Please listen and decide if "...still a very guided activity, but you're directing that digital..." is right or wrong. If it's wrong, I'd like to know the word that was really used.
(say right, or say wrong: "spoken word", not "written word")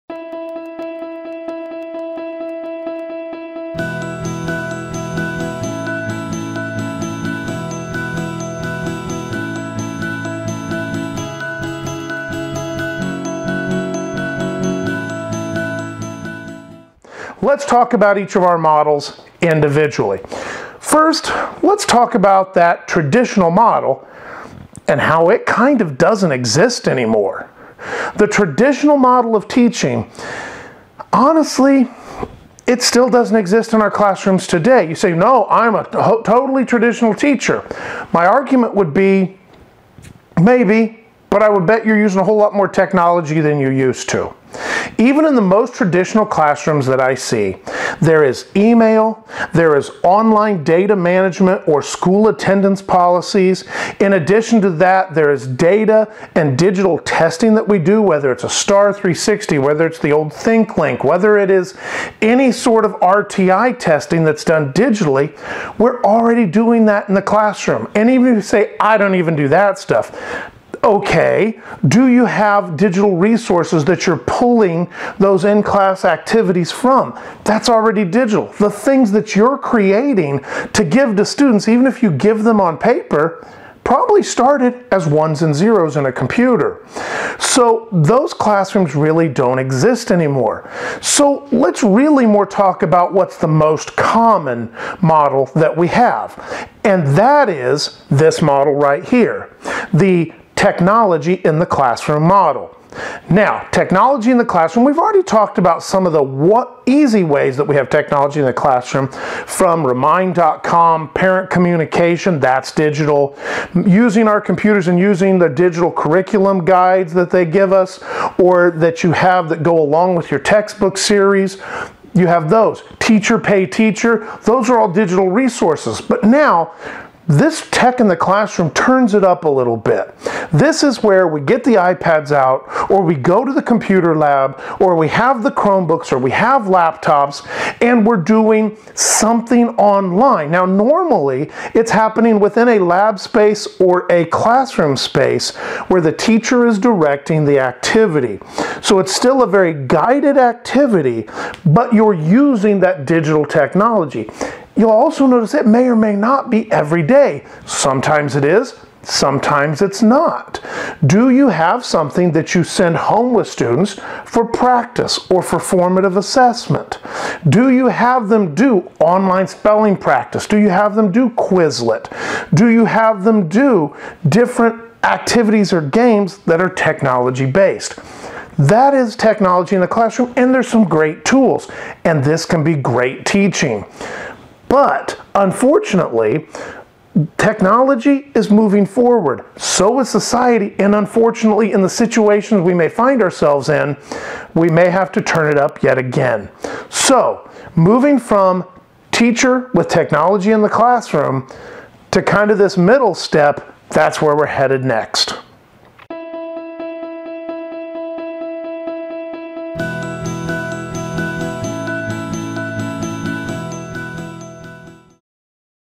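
wrong: "using", not "directing".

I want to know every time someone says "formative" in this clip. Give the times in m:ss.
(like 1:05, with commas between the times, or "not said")
2:45.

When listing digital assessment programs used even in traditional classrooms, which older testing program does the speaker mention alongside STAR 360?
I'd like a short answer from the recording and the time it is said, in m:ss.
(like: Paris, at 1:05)
ThinkLink, at 1:00.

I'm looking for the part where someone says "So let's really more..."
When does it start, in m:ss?
1:31.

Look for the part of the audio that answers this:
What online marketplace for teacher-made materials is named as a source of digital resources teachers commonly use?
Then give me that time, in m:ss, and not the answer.
2:02.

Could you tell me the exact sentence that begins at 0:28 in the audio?
The traditional model of teaching, honestly, it still doesn't exist in our classrooms today.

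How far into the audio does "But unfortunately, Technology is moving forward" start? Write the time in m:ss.
3:04.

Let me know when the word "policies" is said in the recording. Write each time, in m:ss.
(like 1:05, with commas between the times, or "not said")
0:52.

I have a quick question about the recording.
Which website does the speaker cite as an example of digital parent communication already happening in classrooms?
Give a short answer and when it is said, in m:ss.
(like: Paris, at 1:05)
remind.com, at 1:49.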